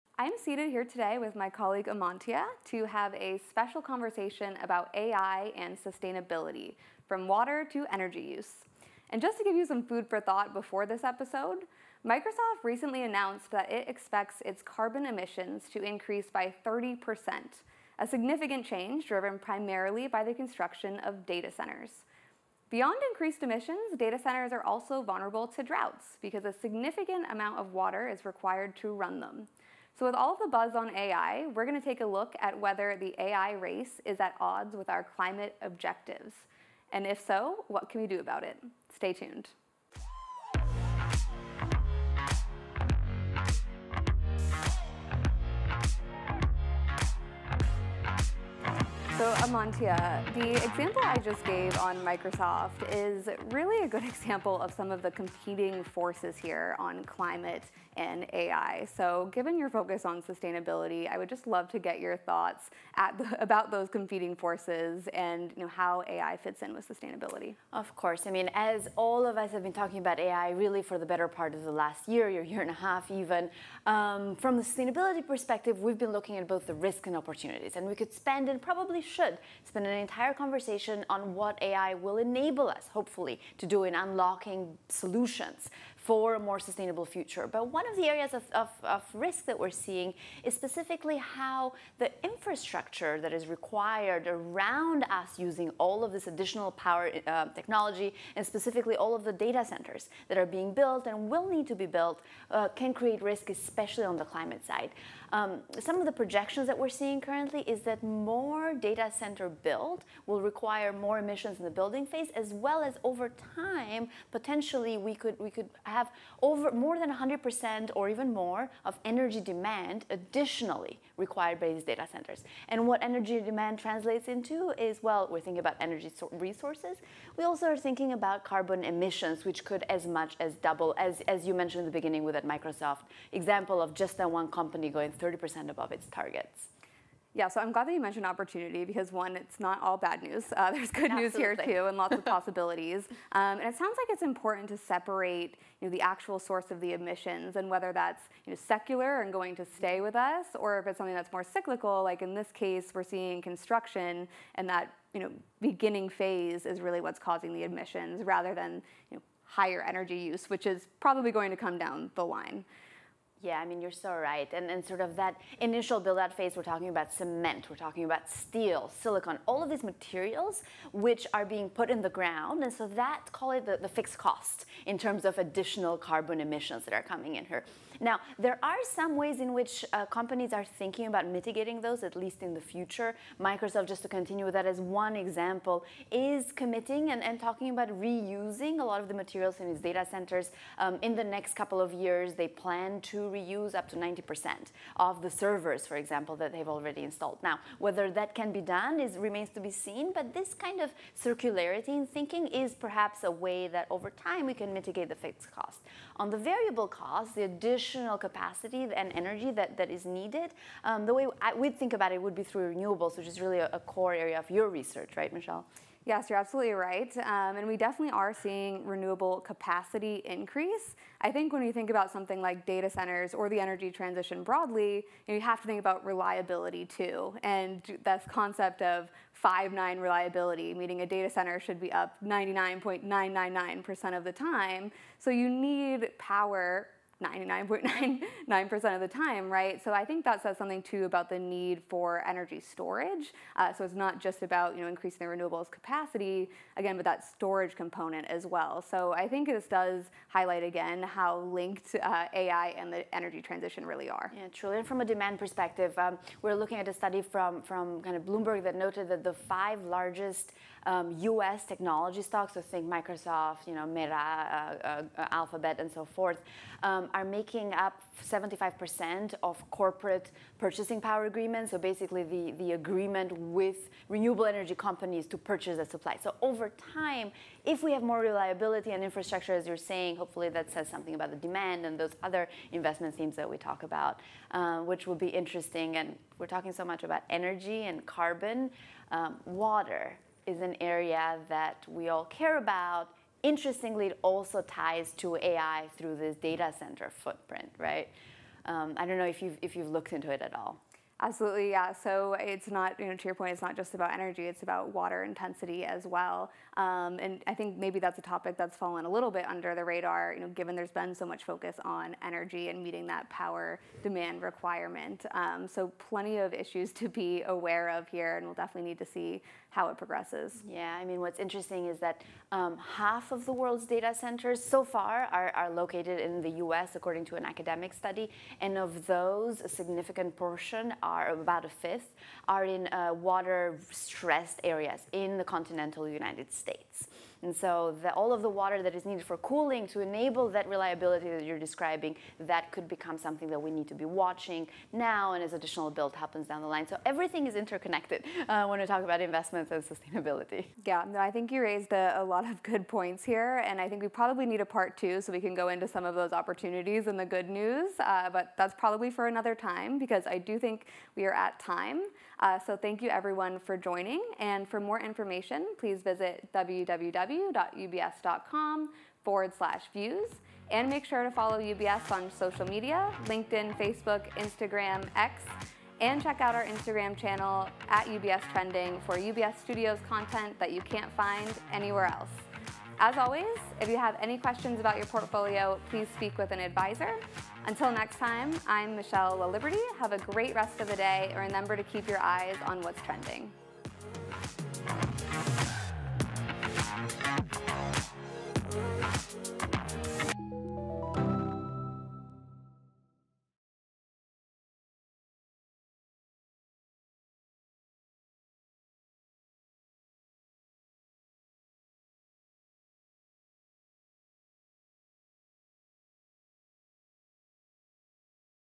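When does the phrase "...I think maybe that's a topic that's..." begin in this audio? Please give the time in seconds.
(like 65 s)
307 s.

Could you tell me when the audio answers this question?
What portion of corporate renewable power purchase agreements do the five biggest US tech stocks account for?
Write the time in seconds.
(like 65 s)
268 s.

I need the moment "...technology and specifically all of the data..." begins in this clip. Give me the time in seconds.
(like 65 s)
97 s.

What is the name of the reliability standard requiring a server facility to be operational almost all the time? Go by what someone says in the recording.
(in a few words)
five nine reliability.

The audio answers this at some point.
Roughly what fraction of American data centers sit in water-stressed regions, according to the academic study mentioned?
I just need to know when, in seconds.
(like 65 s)
331 s.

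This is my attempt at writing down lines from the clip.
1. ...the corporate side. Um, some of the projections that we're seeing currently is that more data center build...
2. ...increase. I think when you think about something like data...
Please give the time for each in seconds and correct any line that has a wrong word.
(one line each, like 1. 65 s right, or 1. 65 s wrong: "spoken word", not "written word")
1. 104 s wrong: "climate", not "corporate"
2. 220 s right.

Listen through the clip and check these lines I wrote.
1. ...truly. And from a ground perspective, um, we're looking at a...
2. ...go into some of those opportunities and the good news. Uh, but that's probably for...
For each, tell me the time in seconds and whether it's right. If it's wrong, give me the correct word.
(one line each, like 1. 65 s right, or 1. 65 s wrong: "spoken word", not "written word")
1. 254 s wrong: "demand", not "ground"
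2. 355 s right.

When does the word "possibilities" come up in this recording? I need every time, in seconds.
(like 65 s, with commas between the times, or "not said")
142 s.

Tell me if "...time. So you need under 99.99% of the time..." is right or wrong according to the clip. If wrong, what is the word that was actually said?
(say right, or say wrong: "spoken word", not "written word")
wrong: "power", not "under".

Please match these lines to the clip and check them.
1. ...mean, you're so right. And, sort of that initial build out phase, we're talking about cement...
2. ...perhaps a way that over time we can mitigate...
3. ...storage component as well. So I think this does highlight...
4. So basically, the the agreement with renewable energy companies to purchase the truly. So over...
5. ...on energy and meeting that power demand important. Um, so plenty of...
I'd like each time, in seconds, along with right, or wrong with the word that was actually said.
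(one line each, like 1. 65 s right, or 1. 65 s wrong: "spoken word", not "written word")
1. 163 s right
2. 202 s right
3. 247 s right
4. 271 s wrong: "supply", not "truly"
5. 311 s wrong: "requirement", not "important".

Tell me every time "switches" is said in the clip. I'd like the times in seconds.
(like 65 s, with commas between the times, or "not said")
not said.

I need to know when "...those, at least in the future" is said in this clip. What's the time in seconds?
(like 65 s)
181 s.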